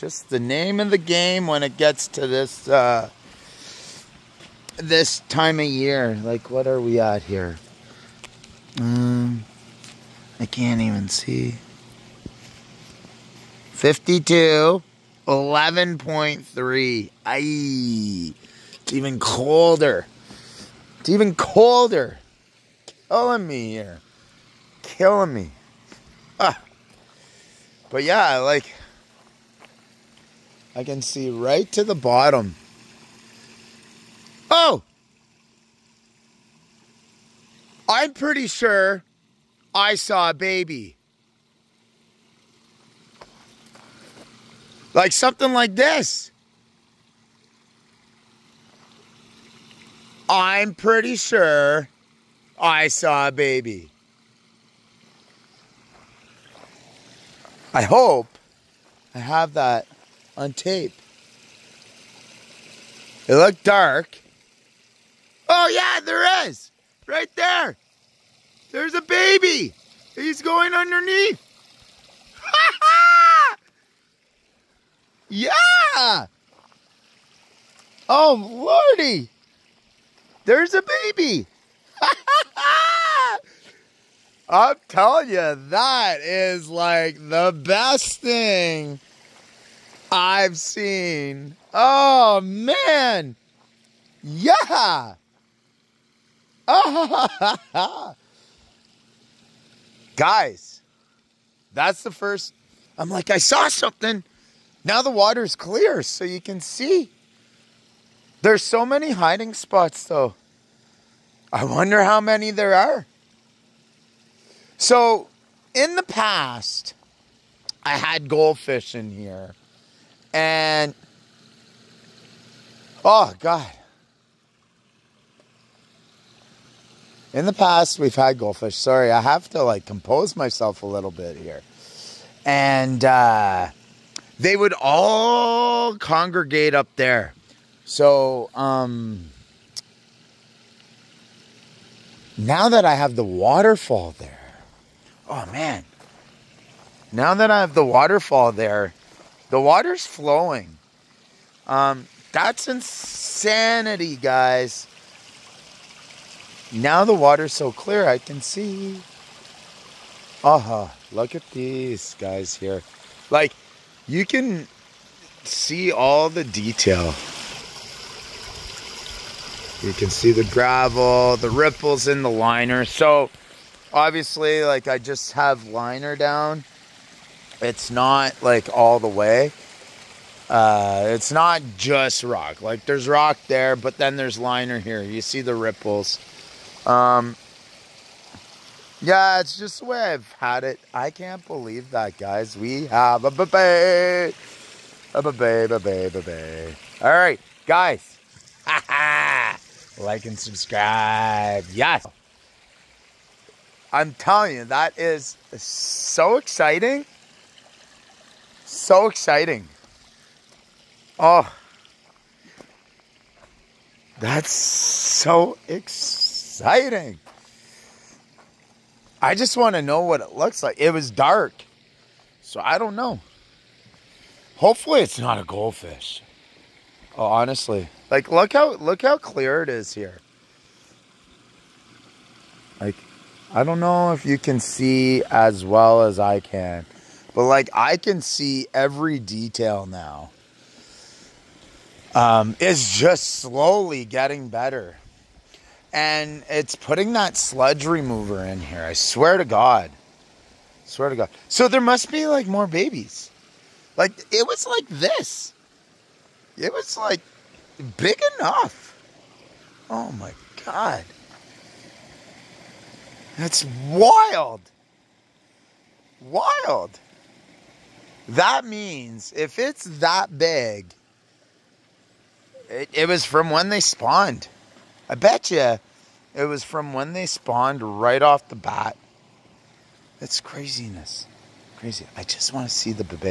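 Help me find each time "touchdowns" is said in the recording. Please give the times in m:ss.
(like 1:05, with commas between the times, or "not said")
not said.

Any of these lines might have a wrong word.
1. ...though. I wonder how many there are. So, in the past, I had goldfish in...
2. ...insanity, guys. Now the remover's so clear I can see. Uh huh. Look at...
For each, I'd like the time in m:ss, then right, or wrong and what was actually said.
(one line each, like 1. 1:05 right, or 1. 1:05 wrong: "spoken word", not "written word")
1. 1:50 right
2. 2:32 wrong: "water", not "remover".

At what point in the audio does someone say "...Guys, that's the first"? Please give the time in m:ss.
1:40.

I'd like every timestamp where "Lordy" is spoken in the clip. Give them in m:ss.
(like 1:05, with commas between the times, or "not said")
1:18.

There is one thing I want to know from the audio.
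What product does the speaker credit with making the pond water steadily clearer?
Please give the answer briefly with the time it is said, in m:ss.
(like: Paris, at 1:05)
sludge remover, at 4:07.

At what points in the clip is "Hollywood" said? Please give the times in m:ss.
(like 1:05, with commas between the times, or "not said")
not said.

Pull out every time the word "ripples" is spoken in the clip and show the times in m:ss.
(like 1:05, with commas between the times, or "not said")
2:51, 3:05.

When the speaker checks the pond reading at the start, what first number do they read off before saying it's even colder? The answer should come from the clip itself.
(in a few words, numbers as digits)
52.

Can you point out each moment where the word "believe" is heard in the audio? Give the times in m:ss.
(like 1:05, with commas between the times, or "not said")
3:11.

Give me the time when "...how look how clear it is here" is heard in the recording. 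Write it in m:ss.
3:48.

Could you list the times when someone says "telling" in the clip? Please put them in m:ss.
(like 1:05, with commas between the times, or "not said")
1:24, 3:24.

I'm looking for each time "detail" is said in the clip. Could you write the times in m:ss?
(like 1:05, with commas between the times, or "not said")
2:46, 3:59.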